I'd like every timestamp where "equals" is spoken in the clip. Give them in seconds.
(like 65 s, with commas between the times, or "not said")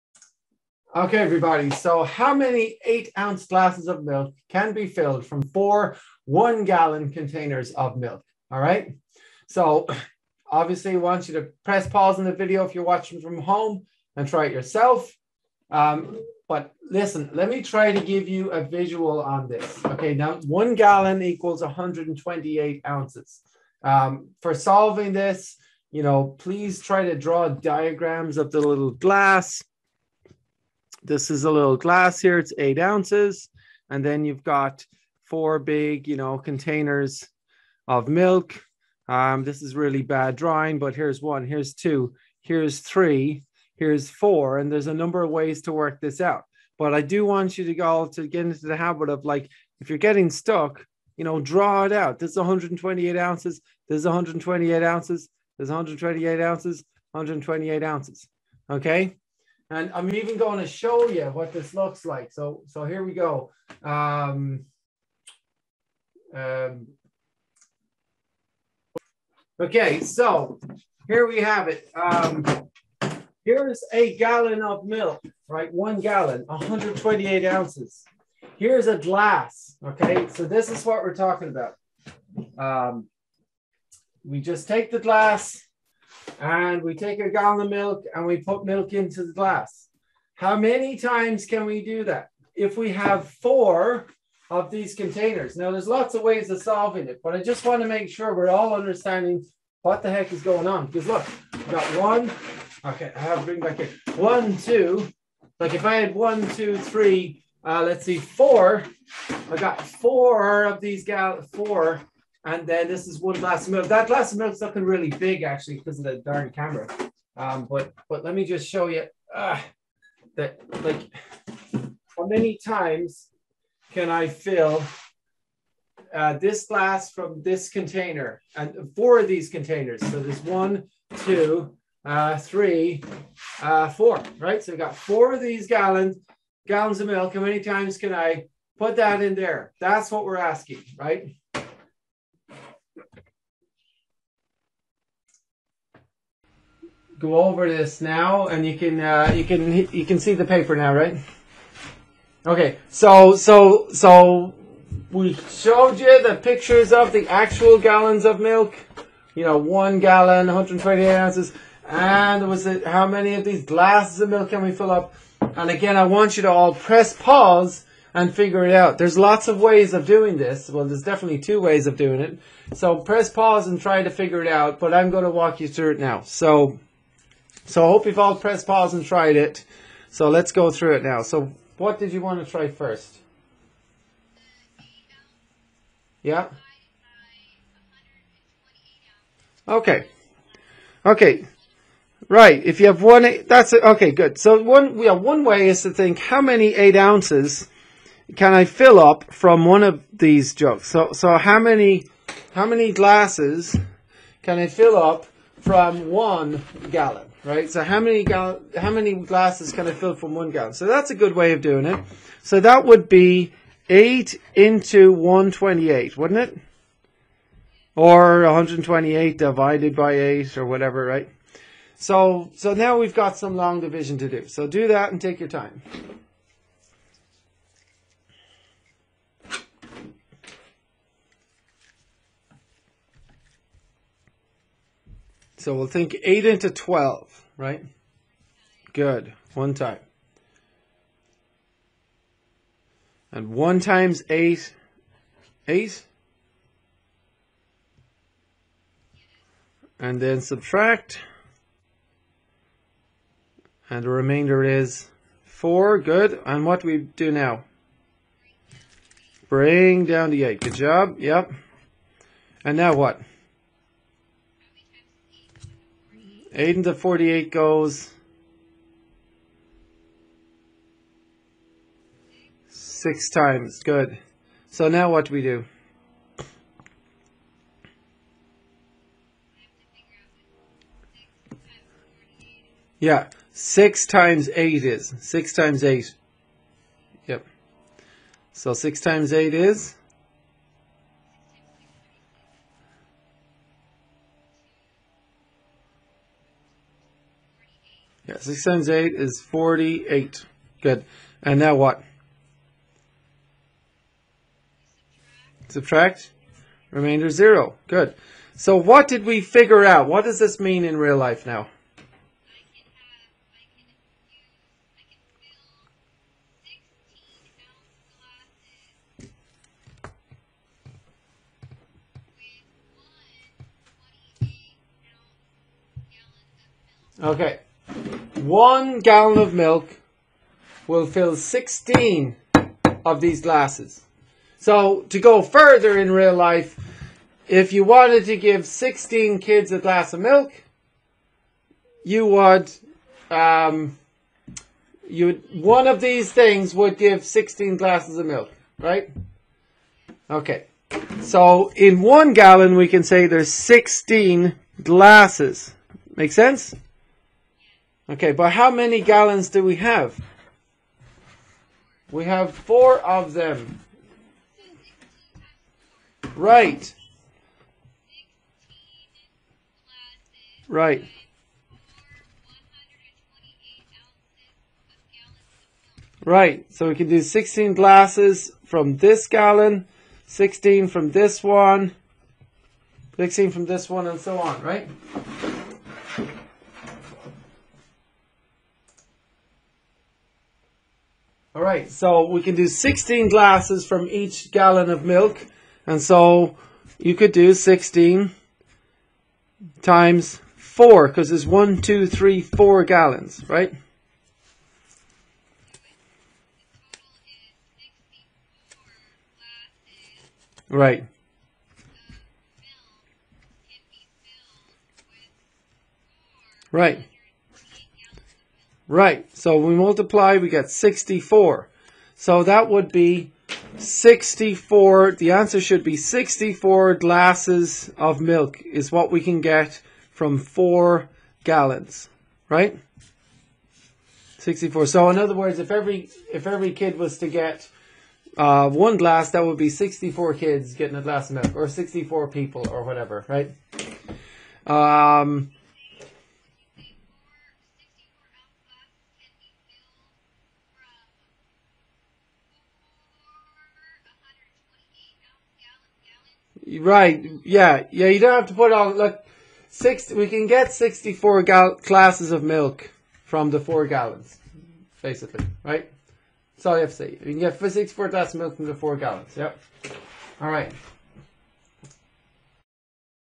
21 s.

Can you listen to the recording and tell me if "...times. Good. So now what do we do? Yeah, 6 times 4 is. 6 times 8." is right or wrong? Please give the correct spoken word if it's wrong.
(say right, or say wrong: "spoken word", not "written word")
wrong: "8", not "4".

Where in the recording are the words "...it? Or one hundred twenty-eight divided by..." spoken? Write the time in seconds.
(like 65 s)
216 s.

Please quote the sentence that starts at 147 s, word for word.
go over this now, and you can uh, you can you can see the paper now, right?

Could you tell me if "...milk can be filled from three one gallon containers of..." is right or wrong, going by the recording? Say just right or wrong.
wrong.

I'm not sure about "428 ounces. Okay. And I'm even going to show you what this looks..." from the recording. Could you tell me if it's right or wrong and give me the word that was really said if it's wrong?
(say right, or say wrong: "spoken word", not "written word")
wrong: "128", not "428".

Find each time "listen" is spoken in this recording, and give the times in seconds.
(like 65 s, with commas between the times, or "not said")
16 s.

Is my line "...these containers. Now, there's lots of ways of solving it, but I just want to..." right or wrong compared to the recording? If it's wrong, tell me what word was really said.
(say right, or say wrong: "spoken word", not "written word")
right.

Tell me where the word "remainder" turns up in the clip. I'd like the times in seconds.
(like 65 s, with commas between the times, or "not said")
254 s, 306 s.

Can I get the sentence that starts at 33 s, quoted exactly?
And then you've got four big, you know, containers of milk.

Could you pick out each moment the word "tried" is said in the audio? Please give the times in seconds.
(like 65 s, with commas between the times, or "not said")
179 s.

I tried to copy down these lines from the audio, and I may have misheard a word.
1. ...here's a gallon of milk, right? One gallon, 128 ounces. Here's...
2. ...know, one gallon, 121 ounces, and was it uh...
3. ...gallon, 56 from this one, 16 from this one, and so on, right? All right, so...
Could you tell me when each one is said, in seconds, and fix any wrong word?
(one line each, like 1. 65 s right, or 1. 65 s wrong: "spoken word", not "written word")
1. 73 s right
2. 159 s wrong: "128", not "121"
3. 379 s wrong: "16", not "56".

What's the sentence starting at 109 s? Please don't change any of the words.
I got four of these gal four and then this is one glass of milk.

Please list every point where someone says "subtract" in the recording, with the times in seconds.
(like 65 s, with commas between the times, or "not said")
250 s, 305 s.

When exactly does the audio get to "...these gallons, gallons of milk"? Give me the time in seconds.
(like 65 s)
135 s.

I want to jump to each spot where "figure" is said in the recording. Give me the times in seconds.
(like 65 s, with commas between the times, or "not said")
168 s, 174 s, 309 s.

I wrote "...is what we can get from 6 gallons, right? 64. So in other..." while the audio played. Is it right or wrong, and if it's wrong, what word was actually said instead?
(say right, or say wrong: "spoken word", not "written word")
wrong: "4", not "6".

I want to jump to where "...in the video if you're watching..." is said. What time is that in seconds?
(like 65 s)
12 s.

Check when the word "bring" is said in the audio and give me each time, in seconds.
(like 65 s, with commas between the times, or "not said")
103 s, 259 s.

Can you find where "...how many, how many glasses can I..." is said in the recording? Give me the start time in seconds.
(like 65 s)
201 s.